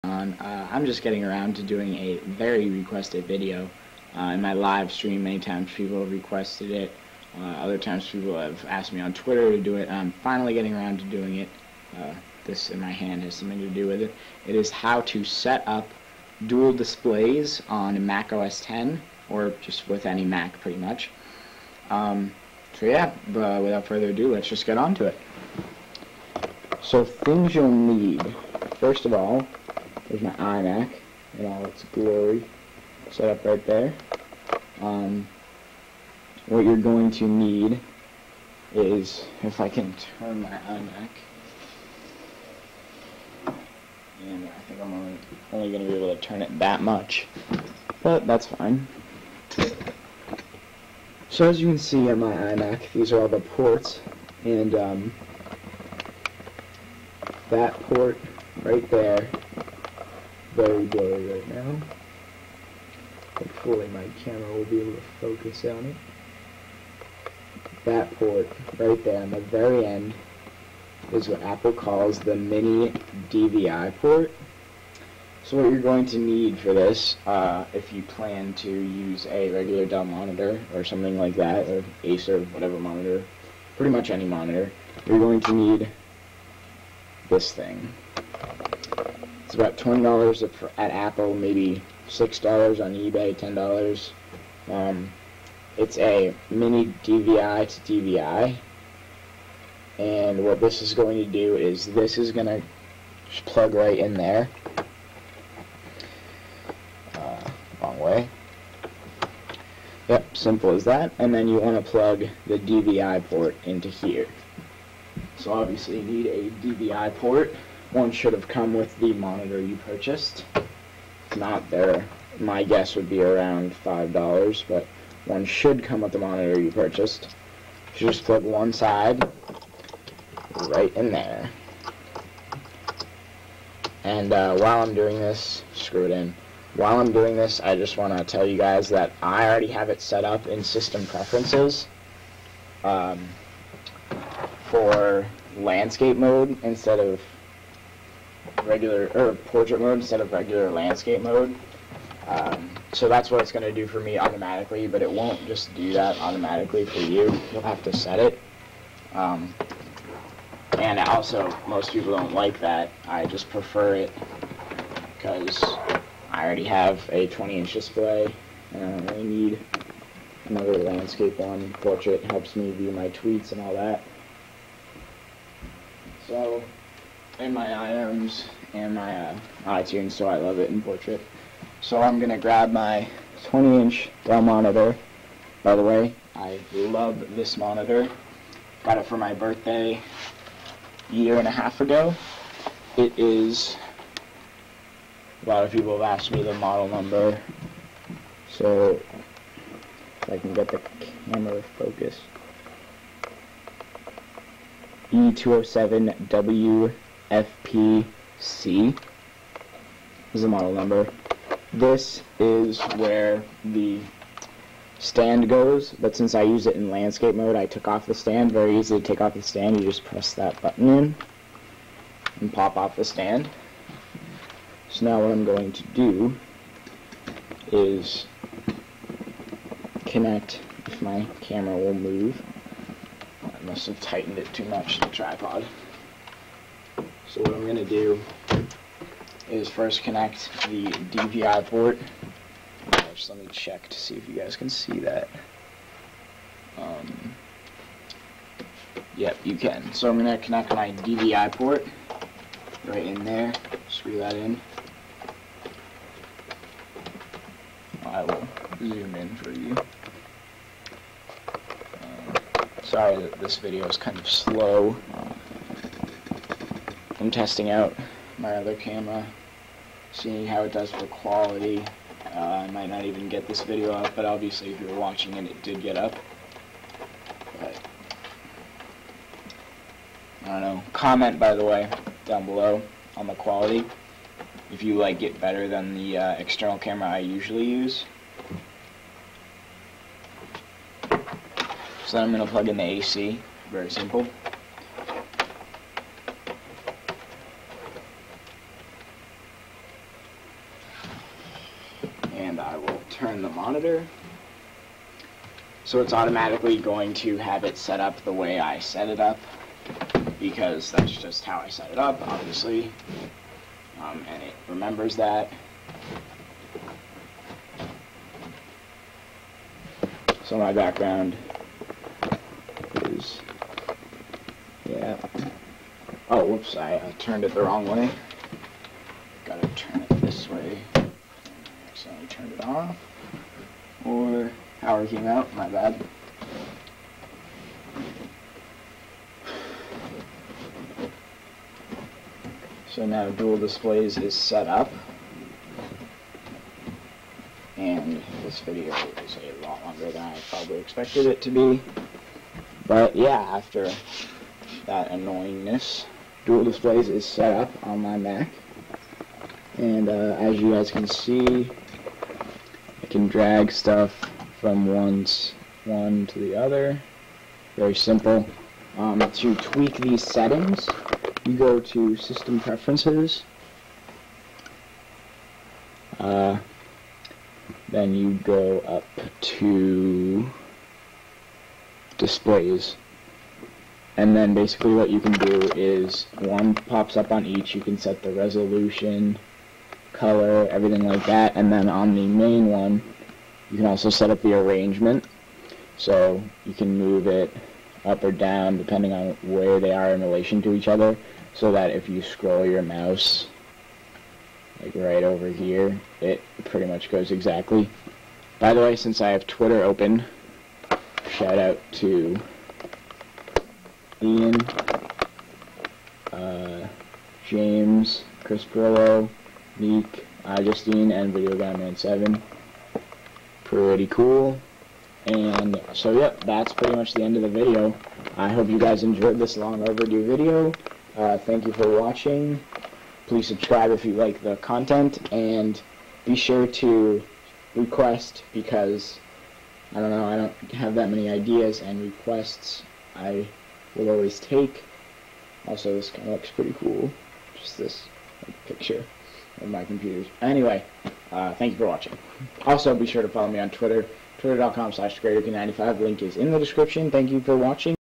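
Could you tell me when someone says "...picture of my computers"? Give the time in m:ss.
7:28.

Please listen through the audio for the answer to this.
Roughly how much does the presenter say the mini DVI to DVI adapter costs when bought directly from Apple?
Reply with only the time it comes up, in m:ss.
1:29.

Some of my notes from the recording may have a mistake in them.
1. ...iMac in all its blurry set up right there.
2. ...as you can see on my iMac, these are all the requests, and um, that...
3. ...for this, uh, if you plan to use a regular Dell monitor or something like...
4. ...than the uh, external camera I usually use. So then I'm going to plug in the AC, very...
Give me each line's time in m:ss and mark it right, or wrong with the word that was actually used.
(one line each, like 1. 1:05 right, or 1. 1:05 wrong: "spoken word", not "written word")
1. 0:30 wrong: "glory", not "blurry"
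2. 0:51 wrong: "ports", not "requests"
3. 1:16 right
4. 4:45 right.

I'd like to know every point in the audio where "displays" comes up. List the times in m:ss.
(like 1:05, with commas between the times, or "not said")
0:16, 2:47, 5:43, 5:56, 6:22.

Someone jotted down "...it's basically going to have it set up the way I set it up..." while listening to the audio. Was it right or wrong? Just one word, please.
wrong.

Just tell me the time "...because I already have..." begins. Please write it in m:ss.
2:45.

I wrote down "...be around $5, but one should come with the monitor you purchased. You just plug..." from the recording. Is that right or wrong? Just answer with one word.
right.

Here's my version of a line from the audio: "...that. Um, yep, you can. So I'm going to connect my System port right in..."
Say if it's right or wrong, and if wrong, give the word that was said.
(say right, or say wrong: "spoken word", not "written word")
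wrong: "DVI", not "System".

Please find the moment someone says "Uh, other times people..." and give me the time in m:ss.
0:07.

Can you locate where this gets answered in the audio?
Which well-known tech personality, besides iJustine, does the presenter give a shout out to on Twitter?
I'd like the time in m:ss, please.
6:58.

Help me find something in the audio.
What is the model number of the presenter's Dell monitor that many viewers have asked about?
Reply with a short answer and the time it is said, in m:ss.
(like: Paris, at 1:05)
E207W FPC, at 3:25.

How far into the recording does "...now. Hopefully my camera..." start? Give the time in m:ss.
1:01.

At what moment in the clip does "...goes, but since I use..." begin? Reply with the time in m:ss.
3:35.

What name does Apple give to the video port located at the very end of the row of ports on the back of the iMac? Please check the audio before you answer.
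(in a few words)
mini DVI port.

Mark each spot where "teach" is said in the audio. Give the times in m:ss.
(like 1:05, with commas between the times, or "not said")
not said.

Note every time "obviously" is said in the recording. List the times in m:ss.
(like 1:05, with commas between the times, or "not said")
1:55, 4:34, 5:12.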